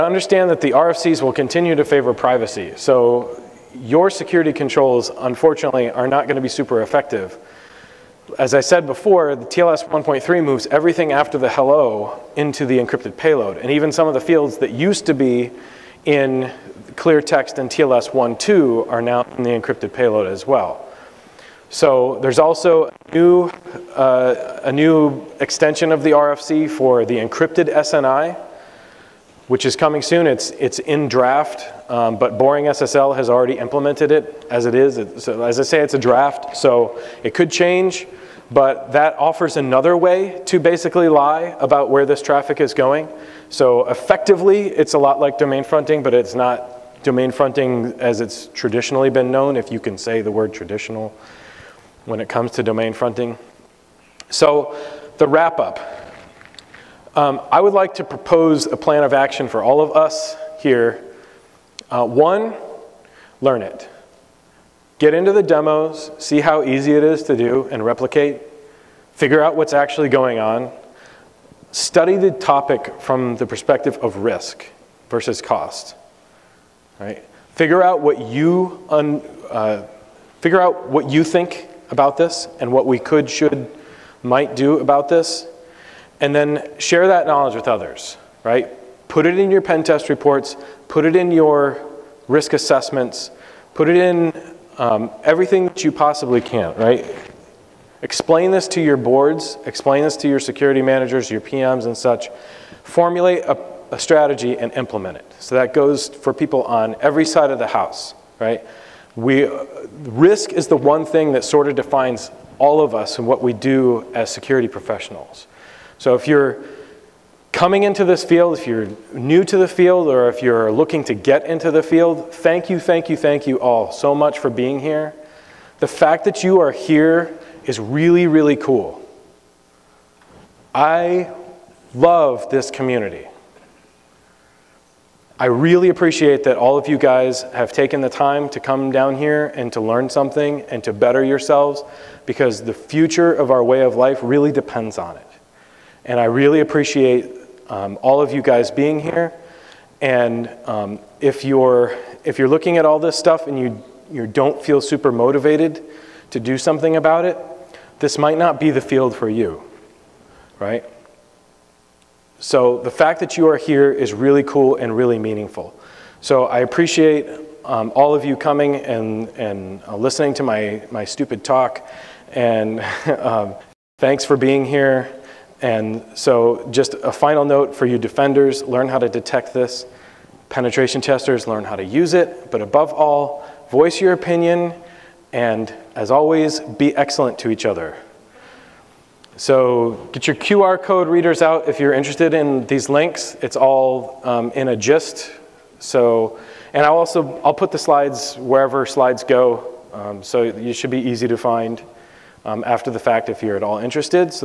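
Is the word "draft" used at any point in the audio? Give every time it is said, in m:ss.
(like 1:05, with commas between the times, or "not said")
0:31, 0:35.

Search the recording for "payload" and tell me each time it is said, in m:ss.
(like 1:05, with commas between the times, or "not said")
0:13, 0:19.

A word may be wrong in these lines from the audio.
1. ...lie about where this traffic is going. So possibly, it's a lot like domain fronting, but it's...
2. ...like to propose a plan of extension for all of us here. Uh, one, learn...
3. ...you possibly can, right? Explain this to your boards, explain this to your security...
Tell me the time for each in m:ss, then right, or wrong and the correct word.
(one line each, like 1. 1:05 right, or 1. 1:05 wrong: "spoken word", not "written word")
1. 0:41 wrong: "effectively", not "possibly"
2. 0:57 wrong: "action", not "extension"
3. 1:35 right.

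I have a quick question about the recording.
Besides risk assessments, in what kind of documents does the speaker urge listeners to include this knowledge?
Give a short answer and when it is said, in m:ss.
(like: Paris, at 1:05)
Pen test reports, at 1:29.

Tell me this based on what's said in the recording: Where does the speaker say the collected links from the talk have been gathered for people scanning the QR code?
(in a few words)
A gist.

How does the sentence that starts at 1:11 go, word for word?
Study the topic from the perspective of risk versus cost.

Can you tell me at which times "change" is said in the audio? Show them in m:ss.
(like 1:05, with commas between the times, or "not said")
0:37.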